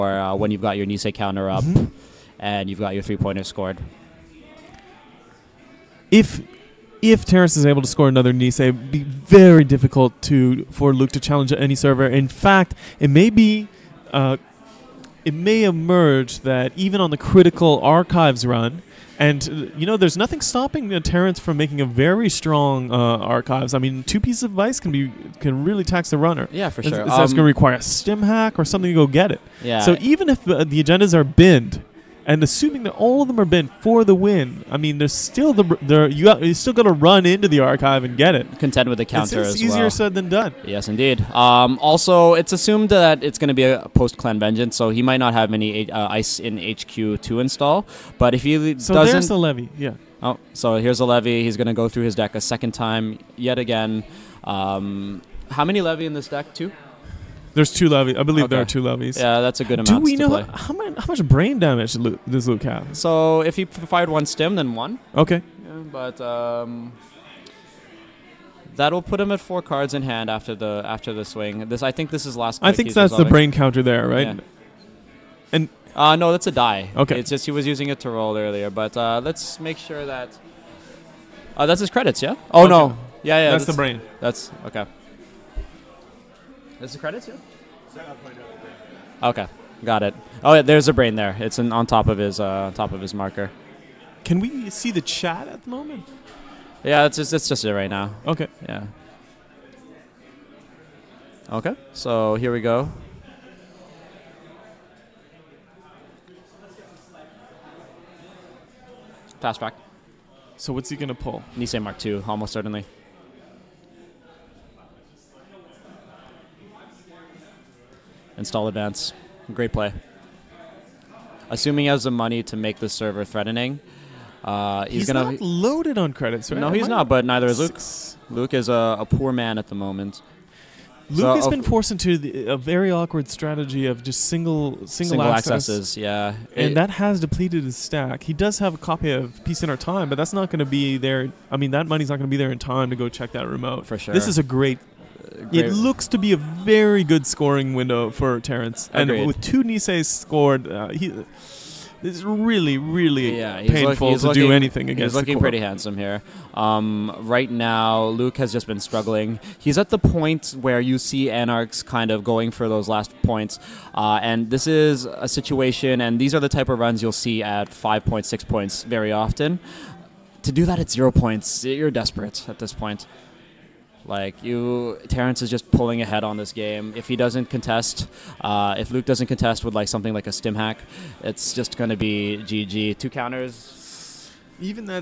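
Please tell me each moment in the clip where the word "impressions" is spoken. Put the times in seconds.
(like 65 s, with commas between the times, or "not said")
not said.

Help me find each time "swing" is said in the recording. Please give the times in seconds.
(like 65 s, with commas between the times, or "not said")
71 s.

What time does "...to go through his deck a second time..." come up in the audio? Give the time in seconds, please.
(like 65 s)
51 s.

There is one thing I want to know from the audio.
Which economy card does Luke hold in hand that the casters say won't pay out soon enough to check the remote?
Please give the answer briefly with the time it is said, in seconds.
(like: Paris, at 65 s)
Peace in Our Time, at 139 s.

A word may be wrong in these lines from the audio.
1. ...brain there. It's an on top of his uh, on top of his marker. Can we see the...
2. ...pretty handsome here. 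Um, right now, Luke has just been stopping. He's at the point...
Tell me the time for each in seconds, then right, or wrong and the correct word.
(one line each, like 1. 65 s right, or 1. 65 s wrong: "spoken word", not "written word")
1. 90 s right
2. 155 s wrong: "struggling", not "stopping".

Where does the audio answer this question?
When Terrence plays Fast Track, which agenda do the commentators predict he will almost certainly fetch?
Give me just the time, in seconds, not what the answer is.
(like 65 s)
111 s.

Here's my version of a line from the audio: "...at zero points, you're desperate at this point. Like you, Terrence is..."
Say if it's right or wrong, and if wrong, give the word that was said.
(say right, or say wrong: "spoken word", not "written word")
right.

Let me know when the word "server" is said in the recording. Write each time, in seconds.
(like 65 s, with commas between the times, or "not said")
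11 s, 122 s.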